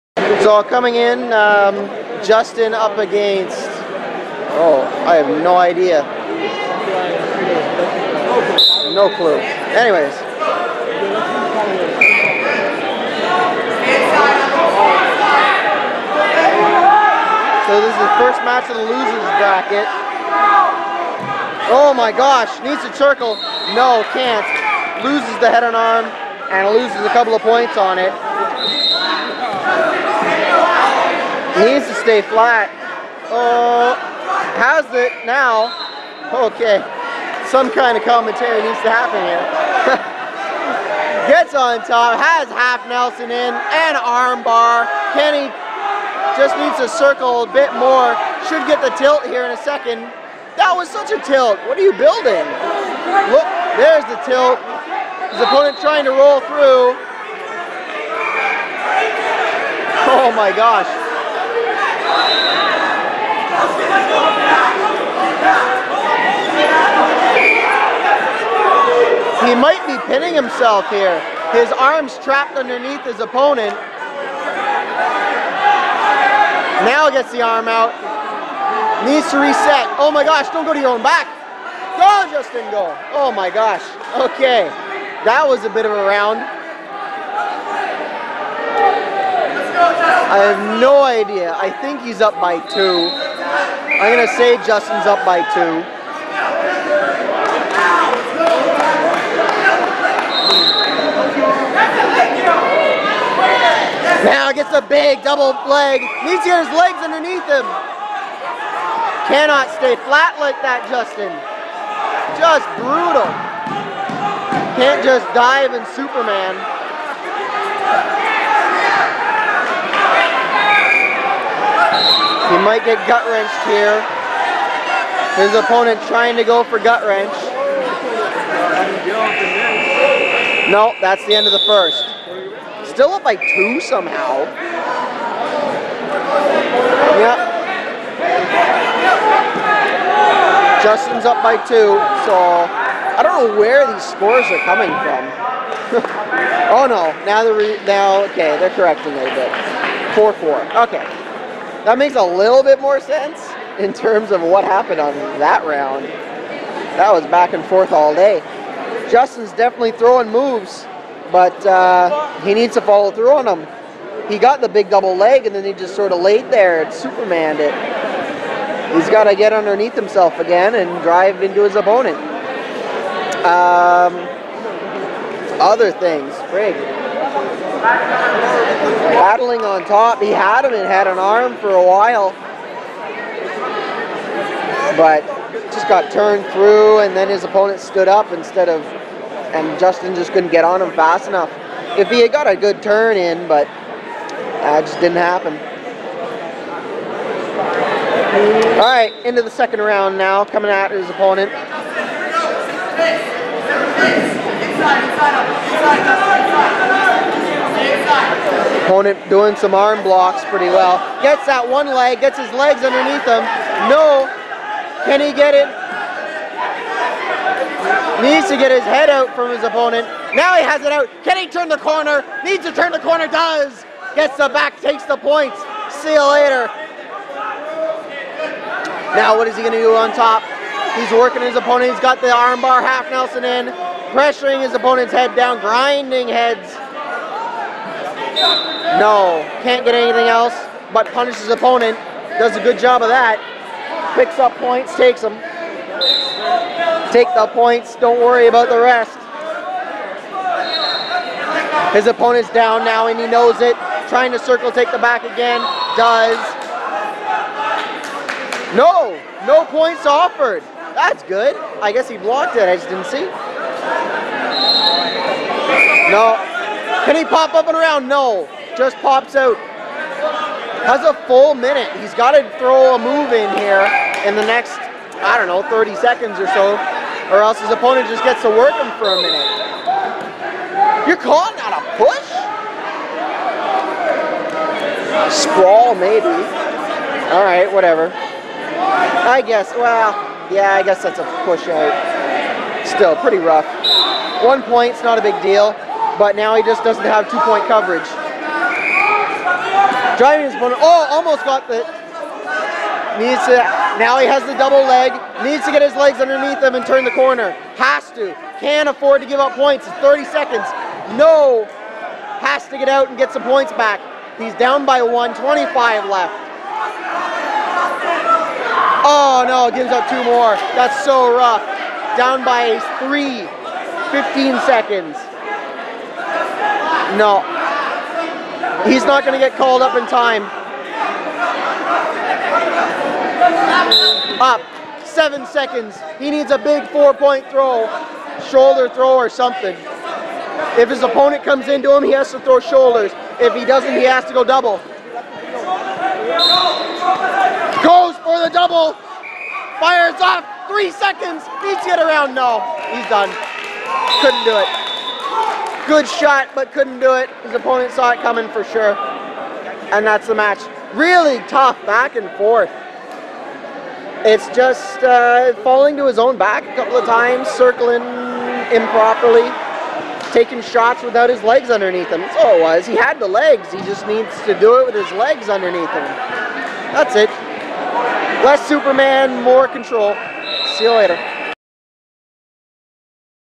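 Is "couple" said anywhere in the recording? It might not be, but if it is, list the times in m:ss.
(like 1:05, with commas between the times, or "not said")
0:27, 6:06.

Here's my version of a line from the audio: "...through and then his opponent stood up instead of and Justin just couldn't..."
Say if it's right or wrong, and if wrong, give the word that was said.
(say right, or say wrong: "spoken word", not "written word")
right.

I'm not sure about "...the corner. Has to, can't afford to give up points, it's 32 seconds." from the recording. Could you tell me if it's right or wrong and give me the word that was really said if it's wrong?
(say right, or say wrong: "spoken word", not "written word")
wrong: "30", not "32".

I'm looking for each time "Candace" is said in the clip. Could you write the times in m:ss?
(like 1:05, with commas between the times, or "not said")
not said.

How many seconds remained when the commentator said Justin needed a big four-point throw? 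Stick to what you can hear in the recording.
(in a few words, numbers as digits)
7.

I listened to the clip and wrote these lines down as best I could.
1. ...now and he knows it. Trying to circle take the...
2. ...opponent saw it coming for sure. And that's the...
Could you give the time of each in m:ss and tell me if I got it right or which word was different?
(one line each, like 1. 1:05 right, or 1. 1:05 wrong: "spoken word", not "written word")
1. 4:12 right
2. 5:57 right.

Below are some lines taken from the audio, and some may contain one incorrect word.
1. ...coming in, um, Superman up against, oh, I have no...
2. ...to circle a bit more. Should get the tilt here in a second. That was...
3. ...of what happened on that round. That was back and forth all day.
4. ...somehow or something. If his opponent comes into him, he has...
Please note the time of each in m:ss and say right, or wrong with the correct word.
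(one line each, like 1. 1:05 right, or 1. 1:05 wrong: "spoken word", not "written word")
1. 0:00 wrong: "Justin", not "Superman"
2. 0:46 right
3. 2:34 right
4. 5:38 wrong: "throw", not "somehow".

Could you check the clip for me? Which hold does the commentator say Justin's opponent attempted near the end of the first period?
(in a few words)
Gut wrench.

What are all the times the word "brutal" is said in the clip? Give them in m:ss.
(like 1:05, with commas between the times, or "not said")
1:52.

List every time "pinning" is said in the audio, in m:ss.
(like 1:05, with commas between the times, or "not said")
1:10.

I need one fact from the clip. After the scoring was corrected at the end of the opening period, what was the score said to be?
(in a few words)
4-4.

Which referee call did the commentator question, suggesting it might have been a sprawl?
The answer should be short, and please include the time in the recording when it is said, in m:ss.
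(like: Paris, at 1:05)
Push out, at 4:51.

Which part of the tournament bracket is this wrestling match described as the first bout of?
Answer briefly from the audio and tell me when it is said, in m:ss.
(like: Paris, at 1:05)
Losers bracket, at 0:18.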